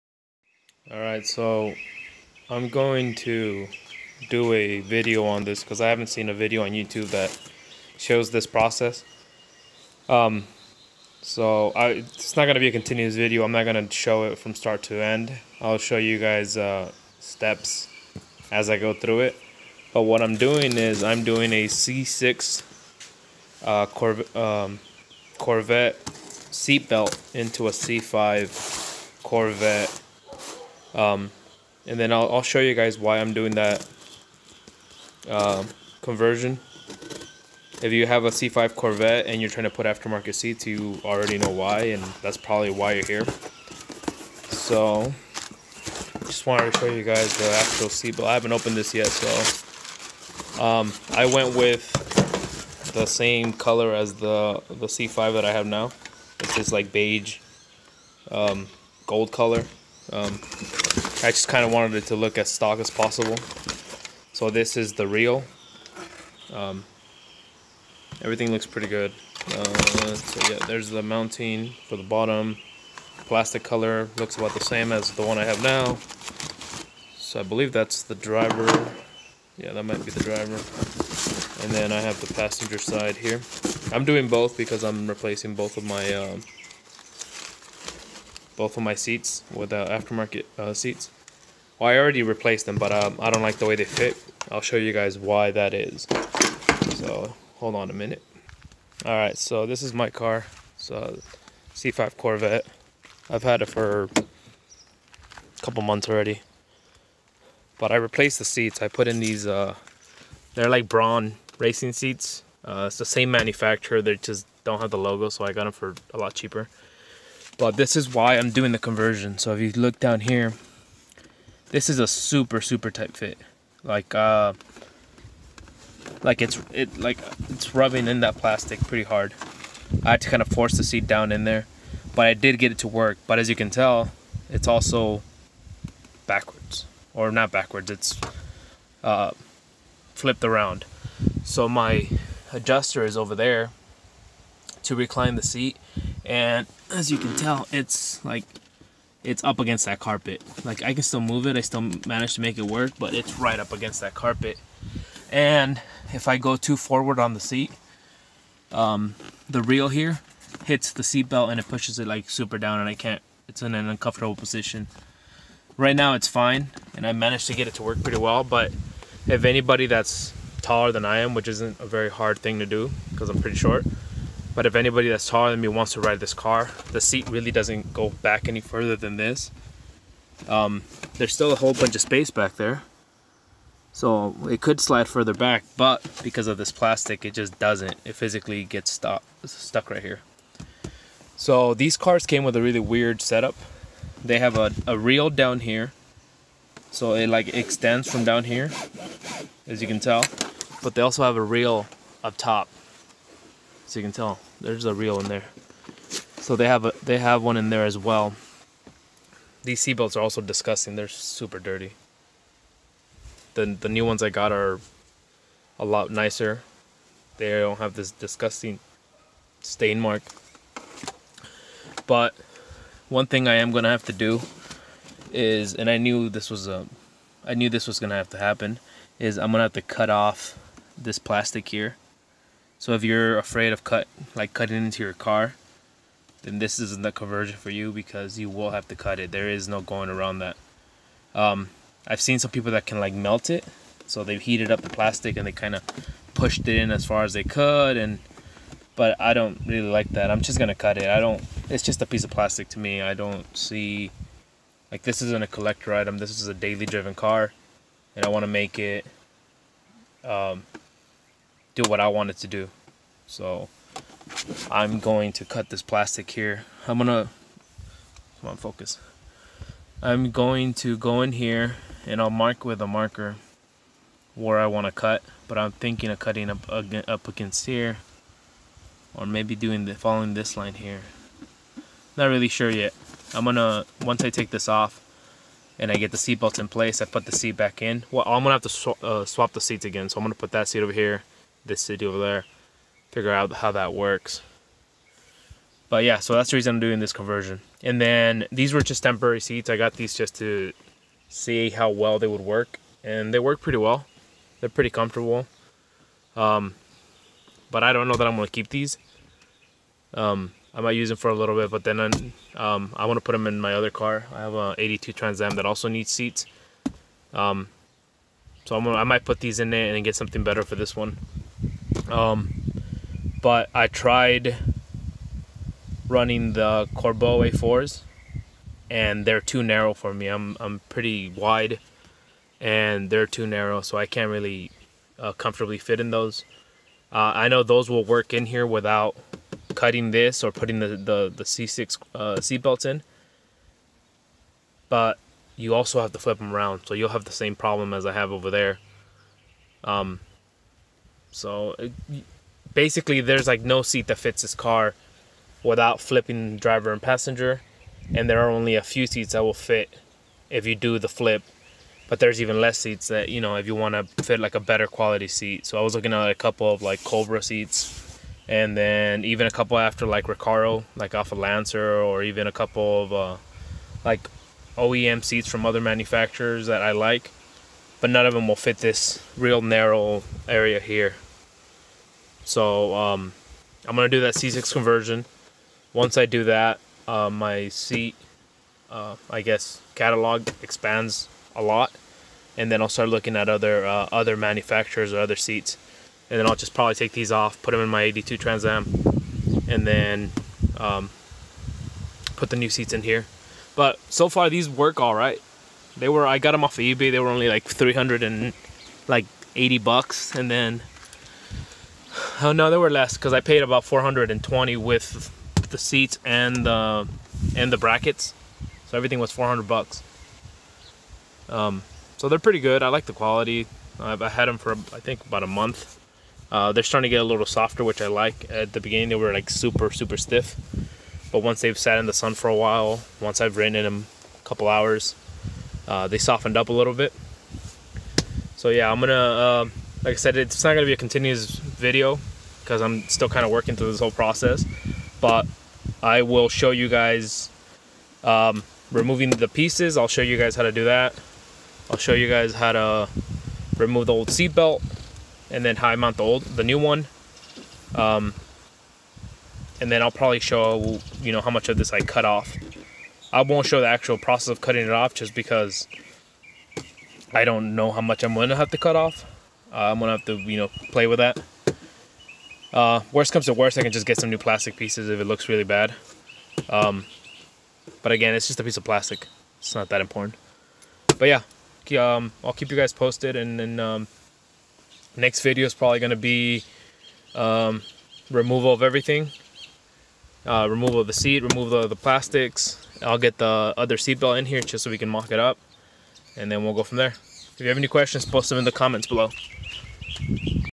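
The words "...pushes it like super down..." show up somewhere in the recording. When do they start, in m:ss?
2:41.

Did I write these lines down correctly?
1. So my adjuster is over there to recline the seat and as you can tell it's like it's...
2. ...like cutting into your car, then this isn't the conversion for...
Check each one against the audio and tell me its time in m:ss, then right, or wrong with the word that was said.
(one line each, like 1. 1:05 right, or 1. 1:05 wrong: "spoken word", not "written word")
1. 2:21 right
2. 3:54 right.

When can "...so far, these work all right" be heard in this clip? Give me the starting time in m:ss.
6:44.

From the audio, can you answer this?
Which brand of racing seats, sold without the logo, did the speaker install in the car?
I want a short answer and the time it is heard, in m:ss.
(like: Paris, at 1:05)
Braum, at 1:50.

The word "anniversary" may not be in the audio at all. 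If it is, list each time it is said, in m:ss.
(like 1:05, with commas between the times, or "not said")
not said.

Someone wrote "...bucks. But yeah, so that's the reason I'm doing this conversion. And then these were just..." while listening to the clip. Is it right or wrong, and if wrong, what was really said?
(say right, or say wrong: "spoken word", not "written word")
wrong: "works", not "bucks".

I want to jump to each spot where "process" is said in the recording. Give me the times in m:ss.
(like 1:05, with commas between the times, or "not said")
0:08, 7:24, 7:44.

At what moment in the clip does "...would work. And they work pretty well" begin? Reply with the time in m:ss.
5:02.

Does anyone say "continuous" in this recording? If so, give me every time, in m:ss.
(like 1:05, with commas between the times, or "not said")
0:12, 7:20.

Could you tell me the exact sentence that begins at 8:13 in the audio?
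I'll get the other seatbelt in here just so we can mock it up.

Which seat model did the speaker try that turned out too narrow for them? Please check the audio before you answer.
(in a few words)
Corbeau A4.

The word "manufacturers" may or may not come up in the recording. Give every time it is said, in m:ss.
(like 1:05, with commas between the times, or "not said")
1:53, 6:15, 6:34.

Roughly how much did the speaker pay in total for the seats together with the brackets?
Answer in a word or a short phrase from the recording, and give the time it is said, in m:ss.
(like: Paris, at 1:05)
420, at 6:53.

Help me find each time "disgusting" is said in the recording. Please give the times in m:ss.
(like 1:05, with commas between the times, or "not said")
3:30, 3:38.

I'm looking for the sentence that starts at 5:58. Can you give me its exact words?
And there are only a few seats that will fit if you do the flip.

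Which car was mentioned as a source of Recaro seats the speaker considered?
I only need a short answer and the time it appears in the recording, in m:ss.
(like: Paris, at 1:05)
Lancer, at 6:11.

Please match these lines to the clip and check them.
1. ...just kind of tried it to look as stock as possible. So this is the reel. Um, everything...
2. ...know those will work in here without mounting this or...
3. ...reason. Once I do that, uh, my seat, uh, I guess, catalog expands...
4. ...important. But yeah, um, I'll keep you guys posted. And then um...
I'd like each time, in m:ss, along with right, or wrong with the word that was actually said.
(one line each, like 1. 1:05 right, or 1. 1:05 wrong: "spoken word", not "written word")
1. 1:01 wrong: "wanted", not "tried"
2. 5:37 wrong: "cutting", not "mounting"
3. 6:24 wrong: "conversion", not "reason"
4. 8:00 right.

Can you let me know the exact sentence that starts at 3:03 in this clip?
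So it could slide further back, but because of this plastic, it just doesn't.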